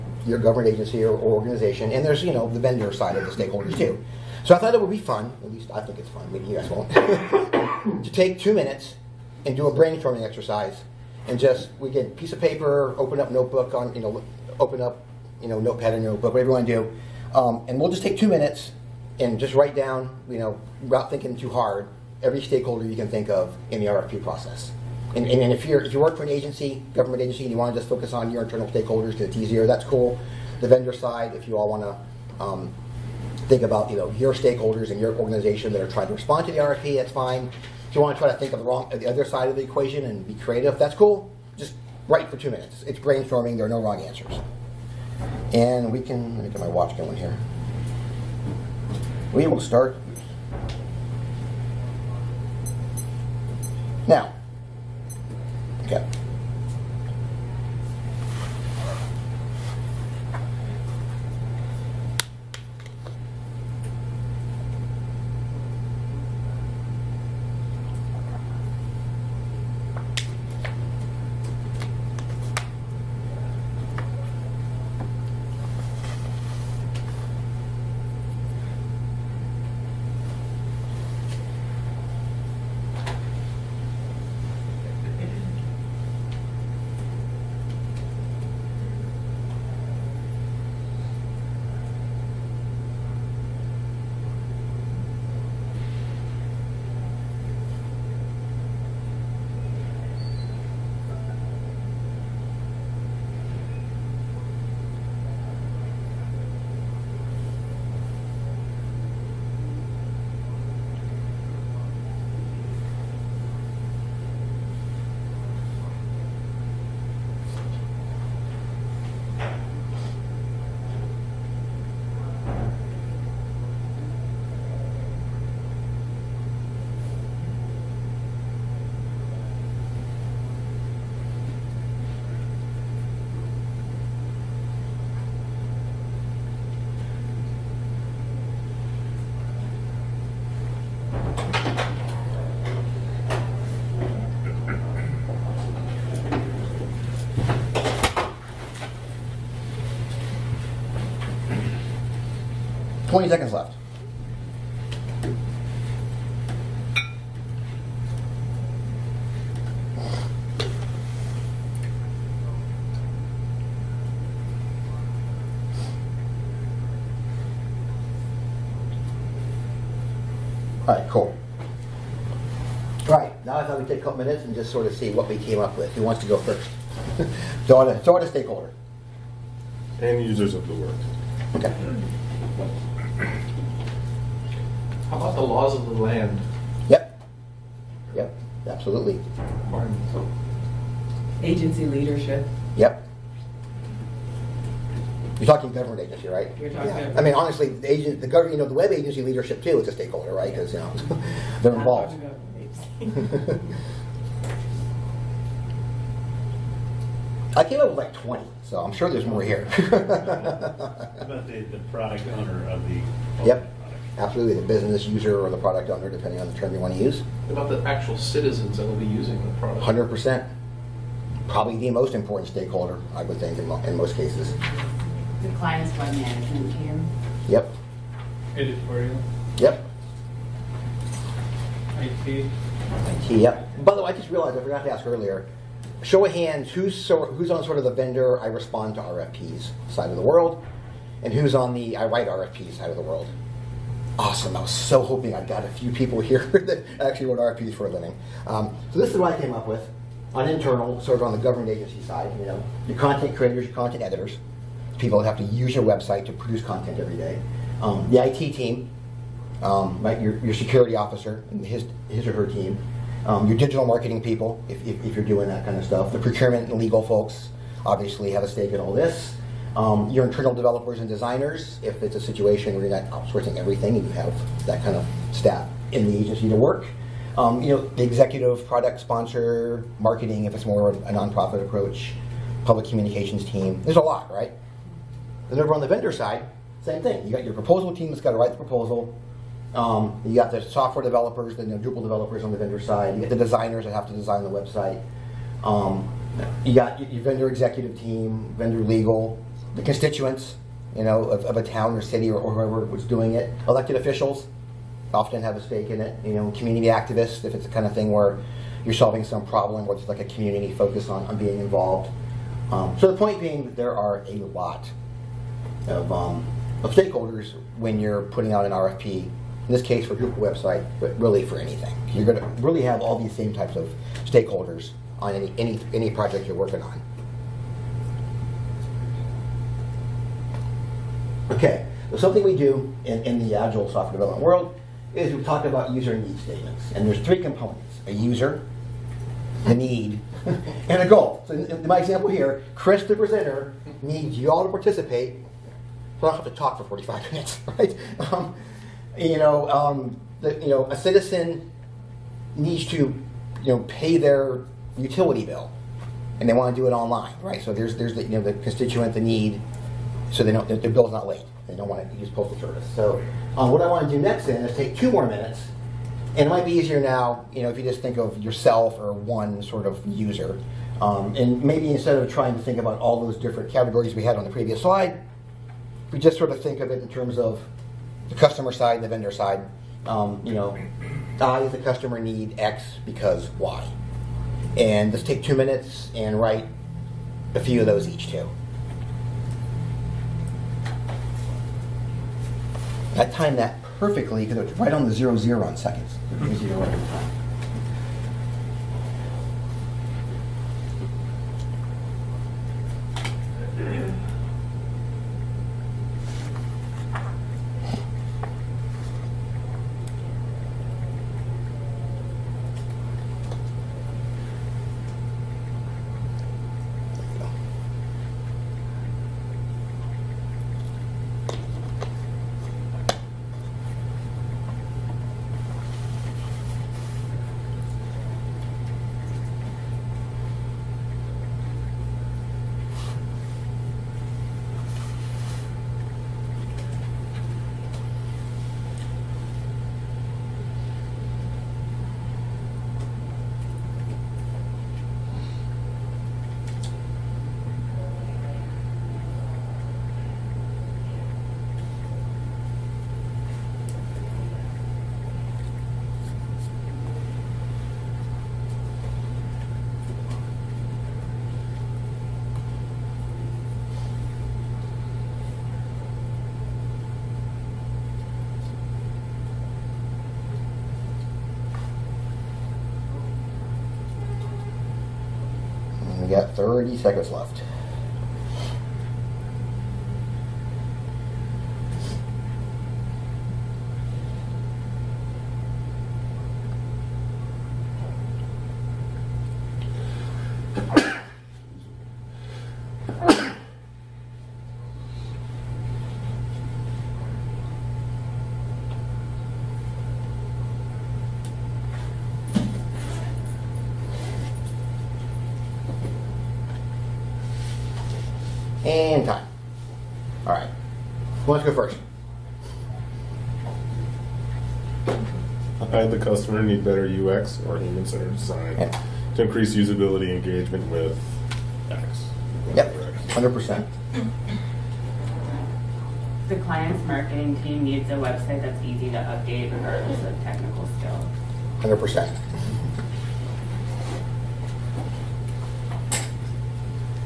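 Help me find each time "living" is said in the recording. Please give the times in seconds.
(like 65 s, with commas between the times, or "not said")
247 s.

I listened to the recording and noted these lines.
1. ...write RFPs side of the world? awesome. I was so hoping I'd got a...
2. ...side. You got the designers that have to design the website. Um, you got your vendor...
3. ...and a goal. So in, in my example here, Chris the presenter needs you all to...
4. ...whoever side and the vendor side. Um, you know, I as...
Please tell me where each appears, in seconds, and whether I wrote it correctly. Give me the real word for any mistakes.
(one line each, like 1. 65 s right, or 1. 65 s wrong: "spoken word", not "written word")
1. 242 s right
2. 292 s right
3. 340 s right
4. 378 s wrong: "customer", not "whoever".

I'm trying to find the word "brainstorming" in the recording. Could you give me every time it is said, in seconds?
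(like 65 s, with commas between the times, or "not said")
9 s, 42 s.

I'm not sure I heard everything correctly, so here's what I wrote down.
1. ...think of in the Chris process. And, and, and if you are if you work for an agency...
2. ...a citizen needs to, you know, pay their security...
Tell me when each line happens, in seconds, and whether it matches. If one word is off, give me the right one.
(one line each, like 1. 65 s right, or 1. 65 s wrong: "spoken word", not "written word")
1. 23 s wrong: "RFP", not "Chris"
2. 350 s wrong: "utility", not "security".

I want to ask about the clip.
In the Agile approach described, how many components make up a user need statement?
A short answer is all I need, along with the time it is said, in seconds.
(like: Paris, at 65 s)
3, at 337 s.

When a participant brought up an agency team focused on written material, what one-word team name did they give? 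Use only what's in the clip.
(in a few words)
Editorial.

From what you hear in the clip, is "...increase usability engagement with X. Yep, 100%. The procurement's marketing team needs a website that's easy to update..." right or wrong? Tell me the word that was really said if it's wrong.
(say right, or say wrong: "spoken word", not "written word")
wrong: "client", not "procurement".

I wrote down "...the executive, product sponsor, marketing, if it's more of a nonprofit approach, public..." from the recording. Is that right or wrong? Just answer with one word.
right.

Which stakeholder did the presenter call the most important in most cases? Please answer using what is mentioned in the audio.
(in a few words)
citizens.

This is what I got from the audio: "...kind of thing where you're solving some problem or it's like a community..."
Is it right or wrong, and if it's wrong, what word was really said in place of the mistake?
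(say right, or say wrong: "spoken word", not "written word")
right.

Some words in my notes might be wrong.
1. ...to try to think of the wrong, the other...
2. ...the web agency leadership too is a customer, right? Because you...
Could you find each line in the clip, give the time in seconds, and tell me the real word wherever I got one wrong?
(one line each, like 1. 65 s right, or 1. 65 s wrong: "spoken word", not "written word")
1. 38 s right
2. 198 s wrong: "stakeholder", not "customer".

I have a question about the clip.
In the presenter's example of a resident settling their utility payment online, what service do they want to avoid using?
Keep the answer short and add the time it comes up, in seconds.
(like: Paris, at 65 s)
postal service, at 362 s.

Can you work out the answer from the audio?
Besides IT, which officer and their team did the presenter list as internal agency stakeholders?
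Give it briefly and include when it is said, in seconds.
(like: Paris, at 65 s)
security officer, at 260 s.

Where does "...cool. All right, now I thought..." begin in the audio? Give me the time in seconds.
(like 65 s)
171 s.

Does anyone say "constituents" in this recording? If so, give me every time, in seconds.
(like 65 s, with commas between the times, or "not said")
299 s, 358 s.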